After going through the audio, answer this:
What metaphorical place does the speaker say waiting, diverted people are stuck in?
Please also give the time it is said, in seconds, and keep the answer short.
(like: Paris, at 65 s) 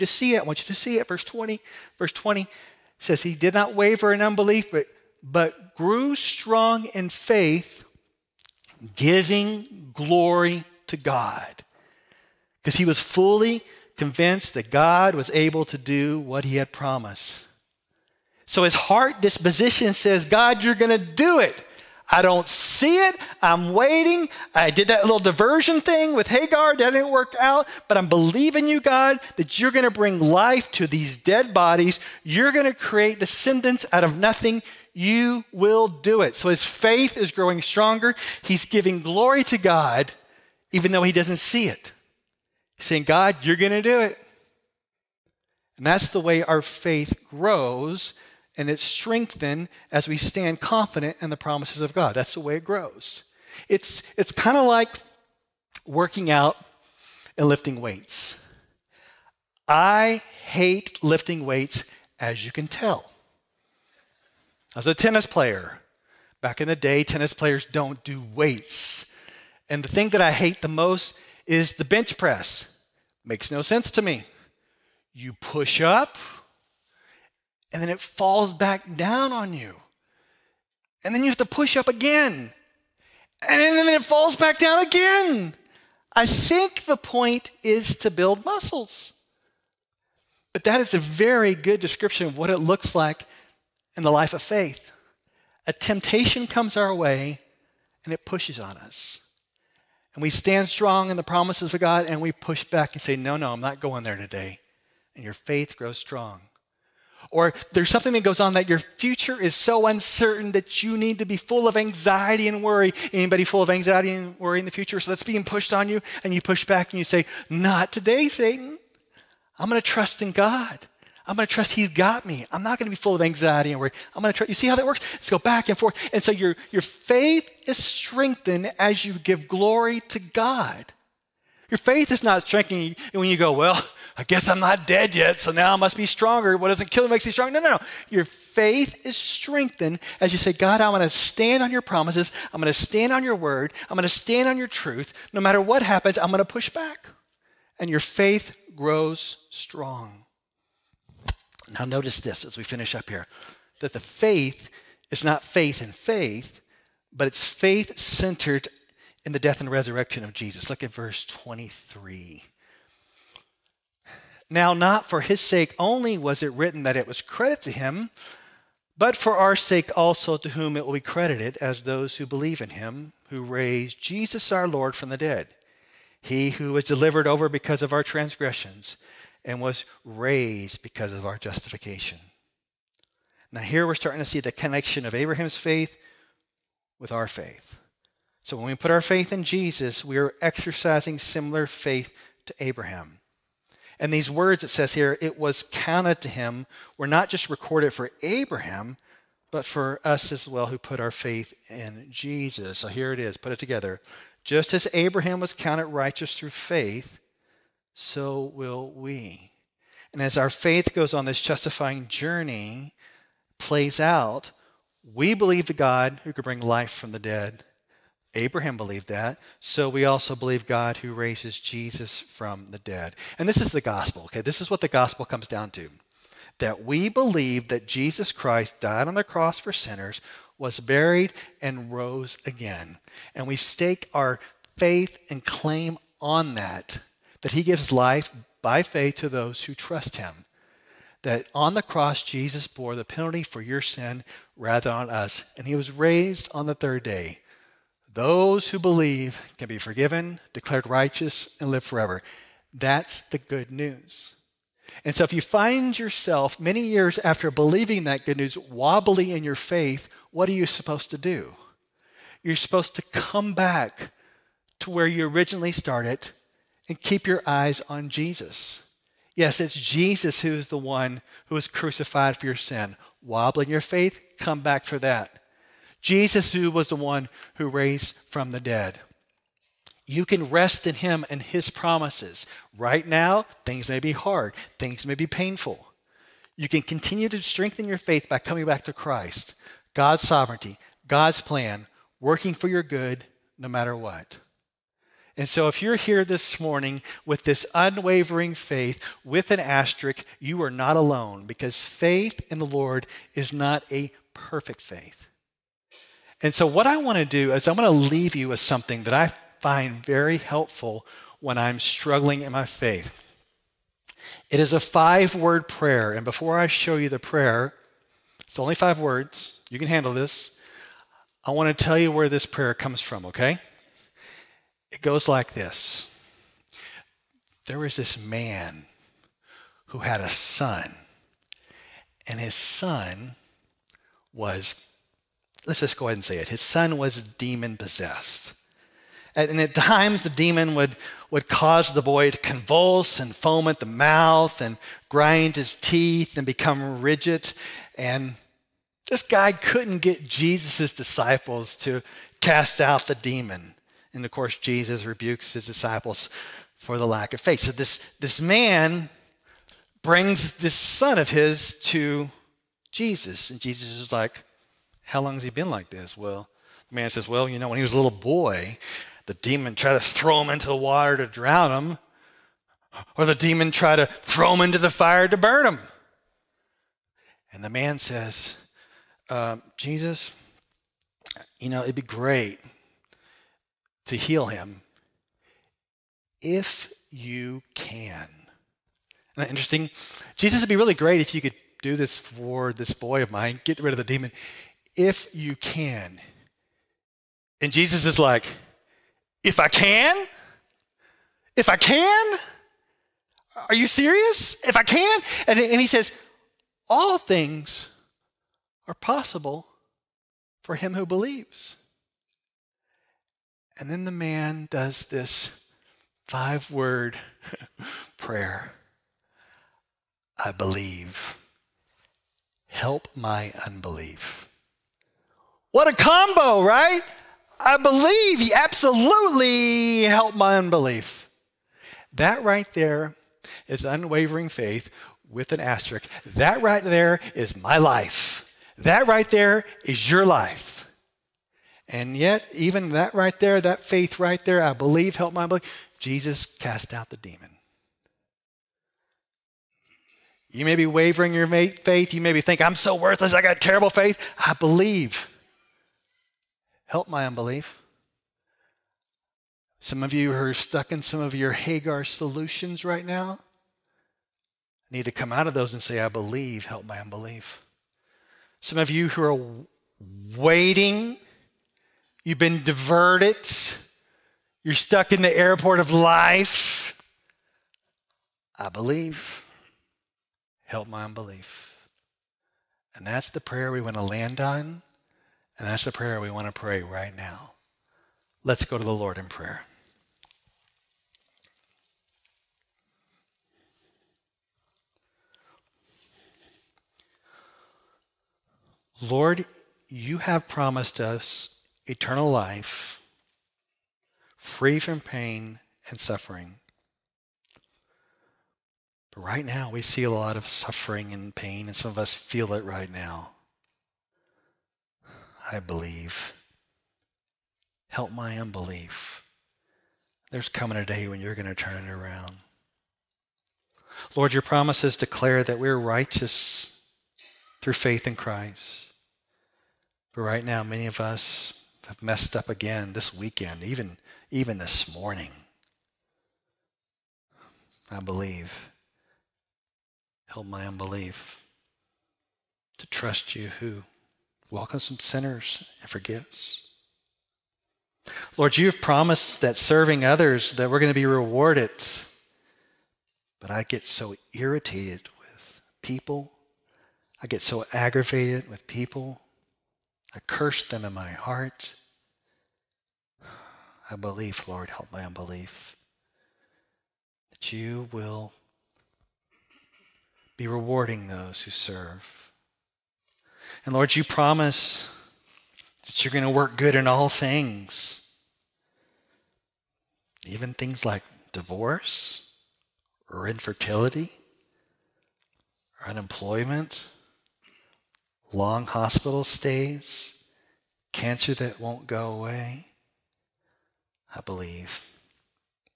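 Airport of life, at 475 s.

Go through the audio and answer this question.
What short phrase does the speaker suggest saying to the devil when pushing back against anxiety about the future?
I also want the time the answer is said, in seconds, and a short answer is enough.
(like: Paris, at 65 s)
Not today, Satan, at 117 s.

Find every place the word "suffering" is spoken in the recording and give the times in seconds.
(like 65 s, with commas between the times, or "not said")
505 s, 510 s.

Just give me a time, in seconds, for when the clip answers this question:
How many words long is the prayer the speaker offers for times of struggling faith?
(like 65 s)
314 s.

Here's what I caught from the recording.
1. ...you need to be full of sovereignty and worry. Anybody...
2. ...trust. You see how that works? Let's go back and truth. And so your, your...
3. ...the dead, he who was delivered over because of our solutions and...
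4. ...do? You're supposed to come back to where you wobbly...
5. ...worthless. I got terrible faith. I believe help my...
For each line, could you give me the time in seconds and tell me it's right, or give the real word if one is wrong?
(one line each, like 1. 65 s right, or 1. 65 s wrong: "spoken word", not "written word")
1. 110 s wrong: "anxiety", not "sovereignty"
2. 124 s wrong: "forth", not "truth"
3. 175 s wrong: "transgressions", not "solutions"
4. 261 s wrong: "originally", not "wobbly"
5. 452 s right.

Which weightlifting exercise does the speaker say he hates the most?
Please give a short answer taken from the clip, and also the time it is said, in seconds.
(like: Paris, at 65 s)
Bench press, at 71 s.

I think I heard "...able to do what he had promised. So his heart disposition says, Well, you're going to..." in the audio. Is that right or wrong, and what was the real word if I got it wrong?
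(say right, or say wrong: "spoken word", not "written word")
wrong: "God", not "Well".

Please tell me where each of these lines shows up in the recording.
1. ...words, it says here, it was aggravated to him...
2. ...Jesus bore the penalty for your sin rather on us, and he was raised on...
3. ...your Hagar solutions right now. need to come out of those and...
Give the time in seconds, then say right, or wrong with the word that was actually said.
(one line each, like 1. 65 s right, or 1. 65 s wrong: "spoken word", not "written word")
1. 194 s wrong: "counted", not "aggravated"
2. 242 s right
3. 461 s right.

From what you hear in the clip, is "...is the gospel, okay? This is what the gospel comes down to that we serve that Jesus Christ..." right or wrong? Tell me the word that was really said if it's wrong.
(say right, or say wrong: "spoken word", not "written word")
wrong: "believe", not "serve".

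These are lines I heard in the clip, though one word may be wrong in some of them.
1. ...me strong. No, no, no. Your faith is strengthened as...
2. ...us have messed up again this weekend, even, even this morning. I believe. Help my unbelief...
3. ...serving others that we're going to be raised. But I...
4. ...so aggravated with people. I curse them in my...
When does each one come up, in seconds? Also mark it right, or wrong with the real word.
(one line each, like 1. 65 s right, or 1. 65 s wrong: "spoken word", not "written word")
1. 137 s right
2. 530 s right
3. 549 s wrong: "rewarded", not "raised"
4. 557 s right.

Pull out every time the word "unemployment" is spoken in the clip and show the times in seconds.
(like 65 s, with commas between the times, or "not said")
585 s.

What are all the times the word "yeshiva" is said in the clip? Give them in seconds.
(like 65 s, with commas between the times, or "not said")
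not said.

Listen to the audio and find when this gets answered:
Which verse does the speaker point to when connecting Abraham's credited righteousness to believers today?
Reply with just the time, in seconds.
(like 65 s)
160 s.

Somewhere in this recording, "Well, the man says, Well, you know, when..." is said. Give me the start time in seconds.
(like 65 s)
366 s.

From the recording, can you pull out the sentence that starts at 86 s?
I think the point is to build muscles.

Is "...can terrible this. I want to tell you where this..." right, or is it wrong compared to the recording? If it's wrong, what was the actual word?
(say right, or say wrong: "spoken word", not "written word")
wrong: "handle", not "terrible".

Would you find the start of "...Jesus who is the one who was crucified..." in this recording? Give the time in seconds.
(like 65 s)
269 s.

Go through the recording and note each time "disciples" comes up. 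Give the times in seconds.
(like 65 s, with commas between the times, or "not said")
350 s, 355 s.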